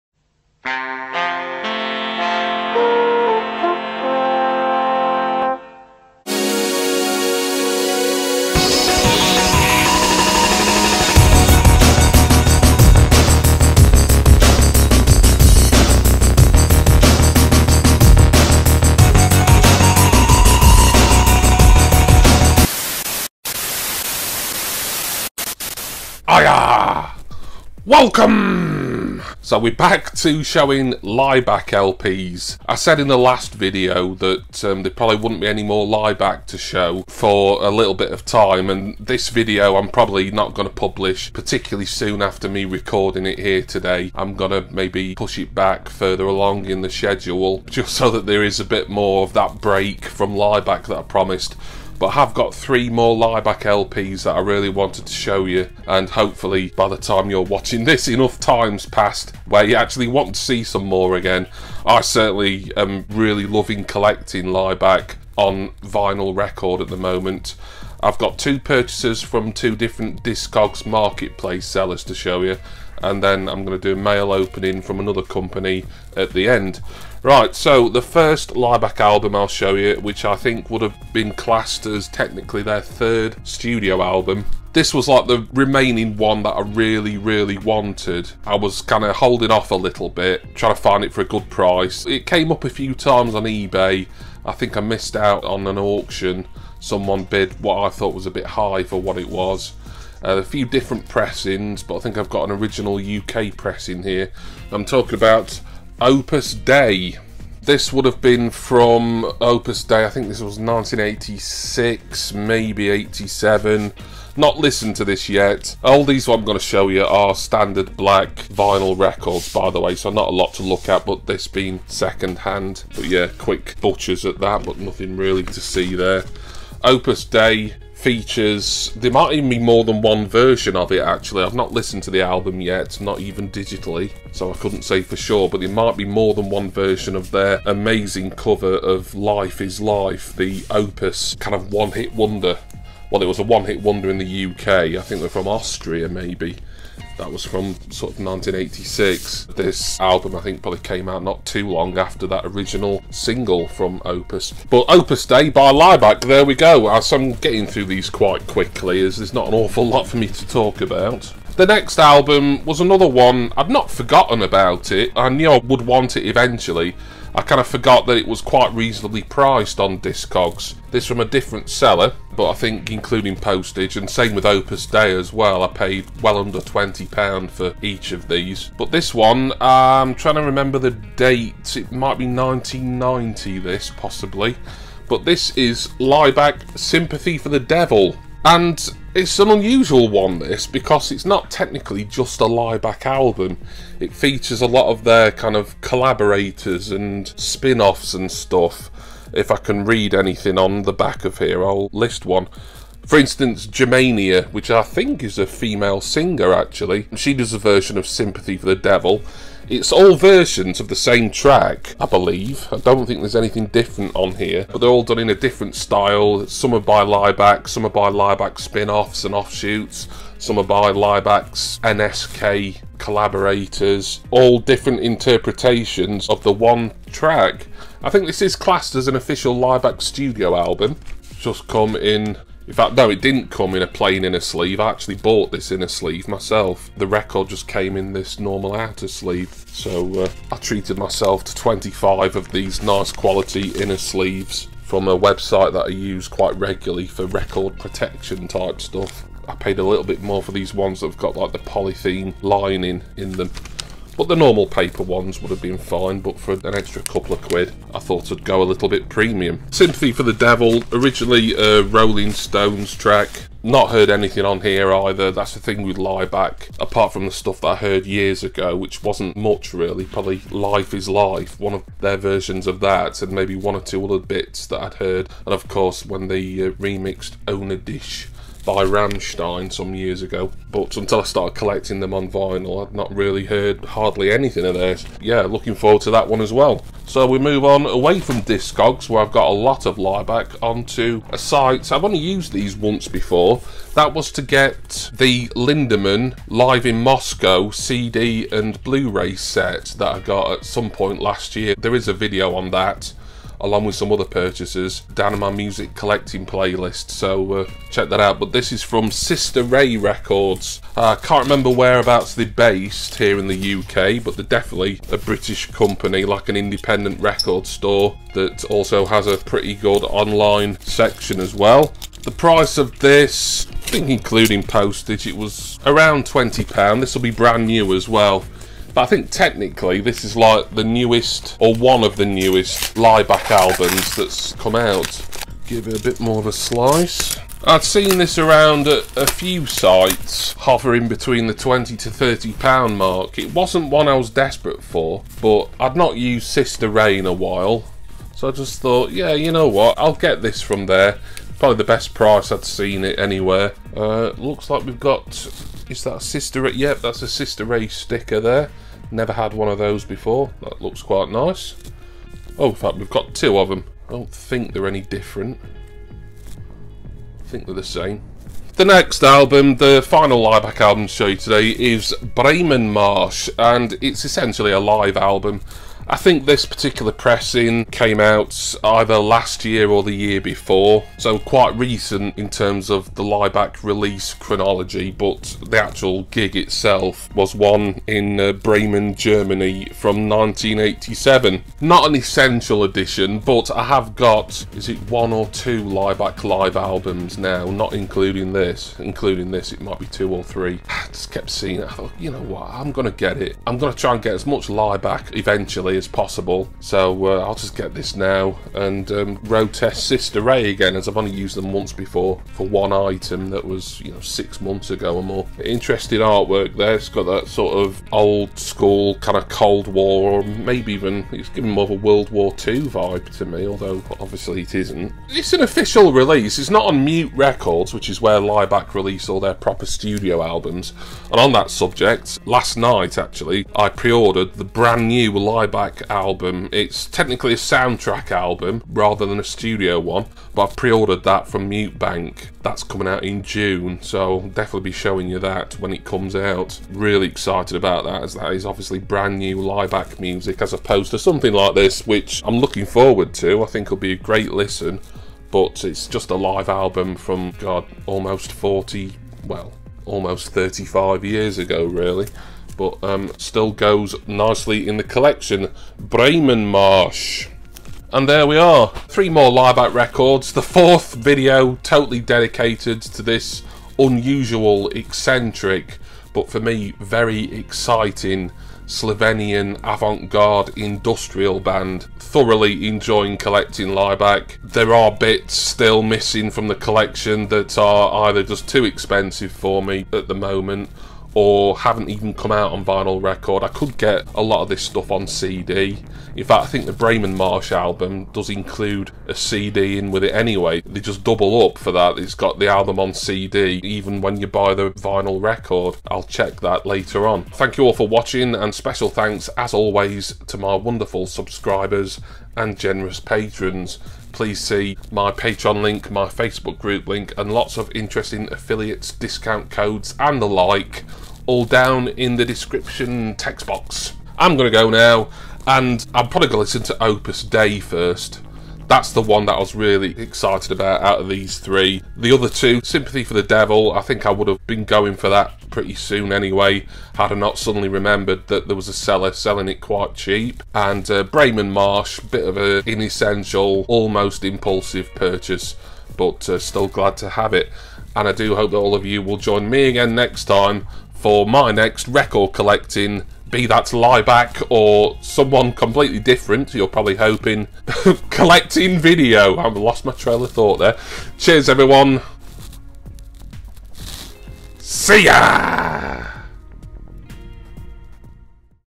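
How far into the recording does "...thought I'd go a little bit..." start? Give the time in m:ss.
4:17.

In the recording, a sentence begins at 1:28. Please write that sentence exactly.
I was kind of holding off a little bit, trying to find it for a good price.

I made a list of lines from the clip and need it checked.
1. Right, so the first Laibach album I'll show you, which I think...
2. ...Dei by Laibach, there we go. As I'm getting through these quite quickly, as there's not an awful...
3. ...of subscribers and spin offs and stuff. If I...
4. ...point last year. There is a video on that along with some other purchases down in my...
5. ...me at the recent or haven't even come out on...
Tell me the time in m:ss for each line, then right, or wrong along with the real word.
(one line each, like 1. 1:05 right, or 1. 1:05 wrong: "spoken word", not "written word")
1. 1:17 right
2. 2:35 right
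3. 3:15 wrong: "collaborators", not "subscribers"
4. 5:00 right
5. 8:09 wrong: "moment", not "recent".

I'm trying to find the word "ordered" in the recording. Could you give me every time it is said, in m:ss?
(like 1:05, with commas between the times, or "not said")
7:13, 7:20.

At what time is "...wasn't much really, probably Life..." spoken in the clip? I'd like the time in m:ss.
4:29.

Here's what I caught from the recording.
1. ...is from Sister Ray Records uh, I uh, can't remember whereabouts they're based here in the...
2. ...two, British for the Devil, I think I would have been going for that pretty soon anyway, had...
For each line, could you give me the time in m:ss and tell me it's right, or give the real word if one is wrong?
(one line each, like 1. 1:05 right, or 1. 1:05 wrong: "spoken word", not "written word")
1. 5:08 right
2. 8:52 wrong: "Sympathy", not "British".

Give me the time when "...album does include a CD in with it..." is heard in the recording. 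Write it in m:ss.
8:17.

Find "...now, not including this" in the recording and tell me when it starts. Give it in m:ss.
6:37.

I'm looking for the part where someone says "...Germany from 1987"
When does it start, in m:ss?
6:29.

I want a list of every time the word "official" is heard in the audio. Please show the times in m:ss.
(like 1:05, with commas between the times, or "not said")
3:49, 7:05.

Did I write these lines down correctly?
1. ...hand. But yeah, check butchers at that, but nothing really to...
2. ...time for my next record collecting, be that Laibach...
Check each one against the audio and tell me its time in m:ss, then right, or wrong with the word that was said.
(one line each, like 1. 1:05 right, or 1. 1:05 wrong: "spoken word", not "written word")
1. 2:02 wrong: "quick", not "check"
2. 9:10 right.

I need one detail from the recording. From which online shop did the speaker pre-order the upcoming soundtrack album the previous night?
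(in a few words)
Mute Bank.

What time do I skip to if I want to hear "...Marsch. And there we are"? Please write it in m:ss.
7:46.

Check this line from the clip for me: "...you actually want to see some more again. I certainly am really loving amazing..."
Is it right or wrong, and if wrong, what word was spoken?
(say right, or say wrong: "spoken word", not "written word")
wrong: "collecting", not "amazing".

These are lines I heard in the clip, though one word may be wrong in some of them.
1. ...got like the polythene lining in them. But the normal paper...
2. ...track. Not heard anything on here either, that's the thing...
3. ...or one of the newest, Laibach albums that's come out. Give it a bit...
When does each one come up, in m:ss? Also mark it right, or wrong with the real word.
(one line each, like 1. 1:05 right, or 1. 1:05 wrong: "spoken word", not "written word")
1. 4:11 right
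2. 4:22 right
3. 5:31 right.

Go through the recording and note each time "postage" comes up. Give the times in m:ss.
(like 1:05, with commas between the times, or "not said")
2:53, 5:24.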